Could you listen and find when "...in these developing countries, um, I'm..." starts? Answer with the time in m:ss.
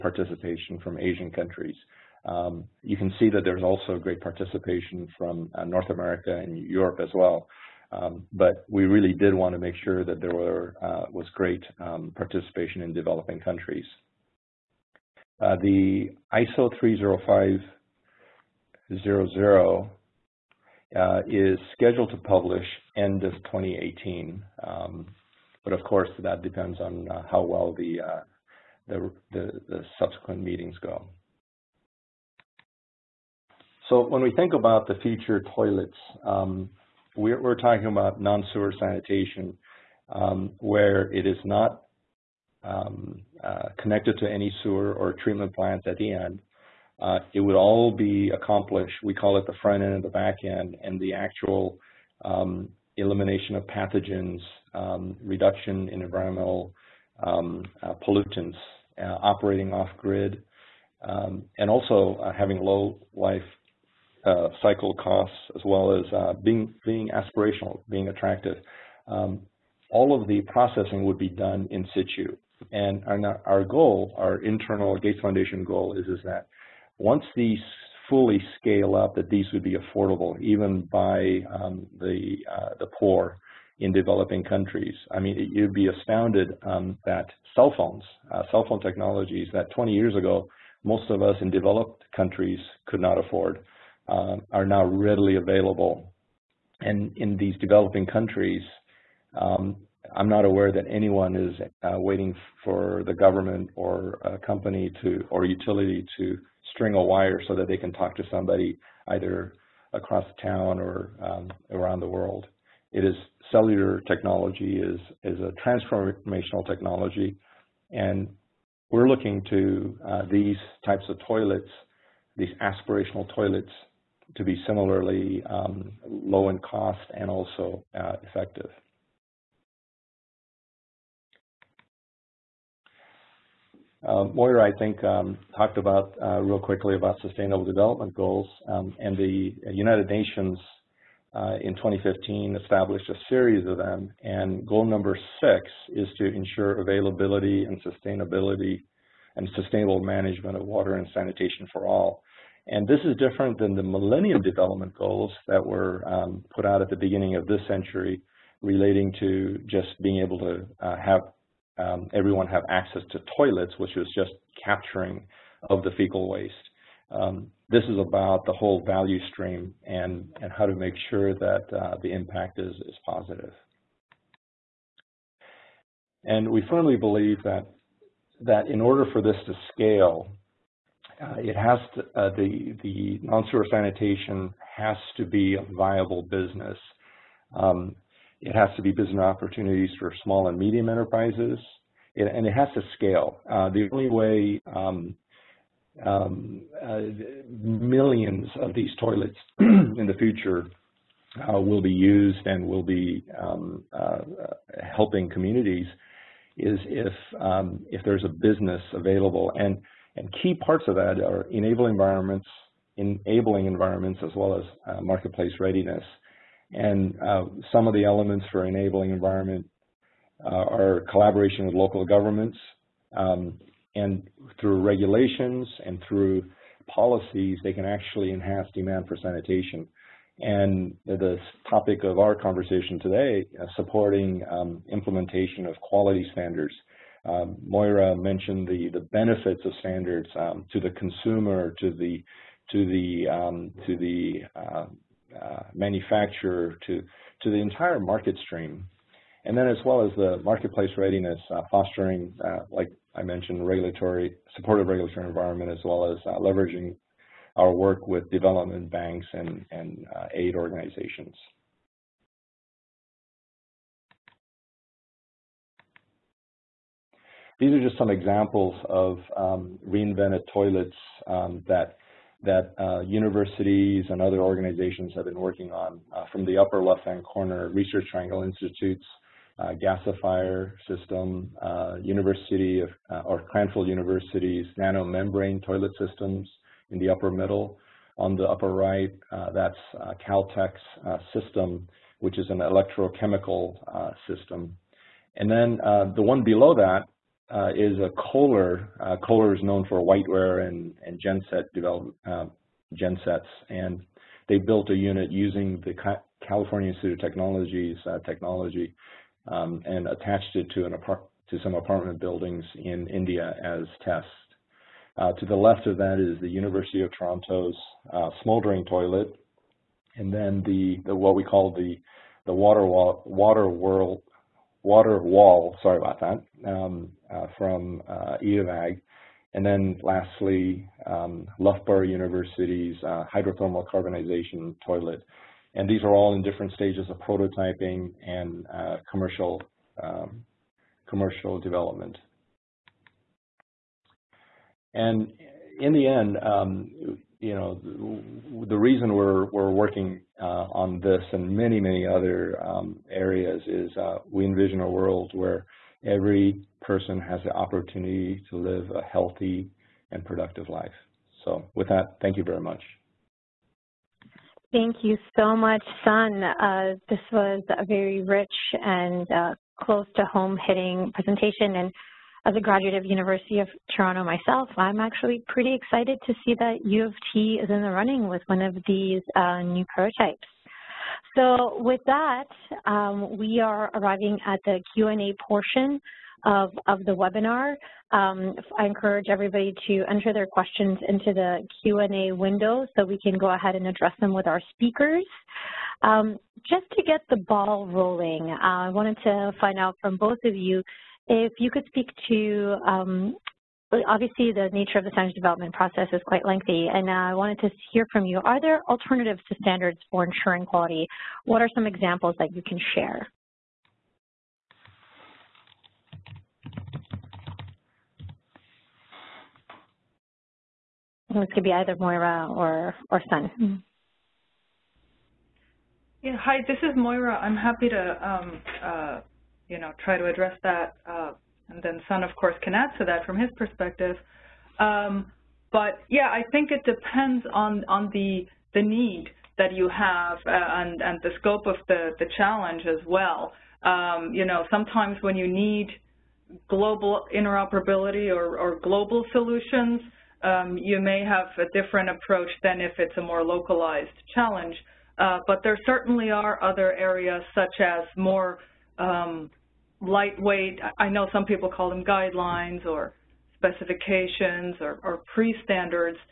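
1:37.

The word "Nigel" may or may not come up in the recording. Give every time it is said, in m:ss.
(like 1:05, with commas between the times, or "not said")
not said.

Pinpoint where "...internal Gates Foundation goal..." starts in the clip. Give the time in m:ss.
1:14.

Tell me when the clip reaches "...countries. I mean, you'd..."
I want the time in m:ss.
1:24.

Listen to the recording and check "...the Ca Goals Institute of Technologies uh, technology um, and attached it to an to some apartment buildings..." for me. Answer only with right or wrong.
wrong.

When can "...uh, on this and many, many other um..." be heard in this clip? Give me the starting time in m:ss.
5:50.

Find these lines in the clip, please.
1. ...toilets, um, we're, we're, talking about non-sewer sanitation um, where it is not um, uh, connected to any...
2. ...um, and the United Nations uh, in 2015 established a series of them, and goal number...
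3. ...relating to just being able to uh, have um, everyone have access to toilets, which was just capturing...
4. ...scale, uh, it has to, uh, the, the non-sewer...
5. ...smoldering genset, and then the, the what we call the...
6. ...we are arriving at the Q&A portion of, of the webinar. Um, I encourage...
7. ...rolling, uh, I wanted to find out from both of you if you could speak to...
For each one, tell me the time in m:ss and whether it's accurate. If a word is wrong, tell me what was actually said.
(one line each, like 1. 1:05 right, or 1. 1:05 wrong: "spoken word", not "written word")
1. 0:35 right
2. 2:18 right
3. 2:38 right
4. 2:59 right
5. 5:18 wrong: "toilet", not "genset"
6. 6:23 right
7. 6:37 right.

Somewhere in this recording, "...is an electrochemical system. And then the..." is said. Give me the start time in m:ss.
4:52.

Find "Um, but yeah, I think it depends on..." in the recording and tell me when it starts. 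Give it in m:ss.
7:14.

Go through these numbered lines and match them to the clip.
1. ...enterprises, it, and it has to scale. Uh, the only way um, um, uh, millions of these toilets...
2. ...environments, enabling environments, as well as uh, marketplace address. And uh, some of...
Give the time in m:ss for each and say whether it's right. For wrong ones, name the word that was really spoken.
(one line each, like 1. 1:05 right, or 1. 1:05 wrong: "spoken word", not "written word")
1. 3:10 right
2. 3:31 wrong: "readiness", not "address".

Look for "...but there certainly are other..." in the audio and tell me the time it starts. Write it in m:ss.
7:35.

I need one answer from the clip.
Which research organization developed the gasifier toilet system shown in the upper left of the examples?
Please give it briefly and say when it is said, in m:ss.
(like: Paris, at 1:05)
Research Triangle Institute, at 4:37.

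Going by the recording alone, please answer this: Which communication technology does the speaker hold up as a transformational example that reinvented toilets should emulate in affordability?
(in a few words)
Cellular technology.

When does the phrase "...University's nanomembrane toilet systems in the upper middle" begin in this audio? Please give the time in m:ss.
4:43.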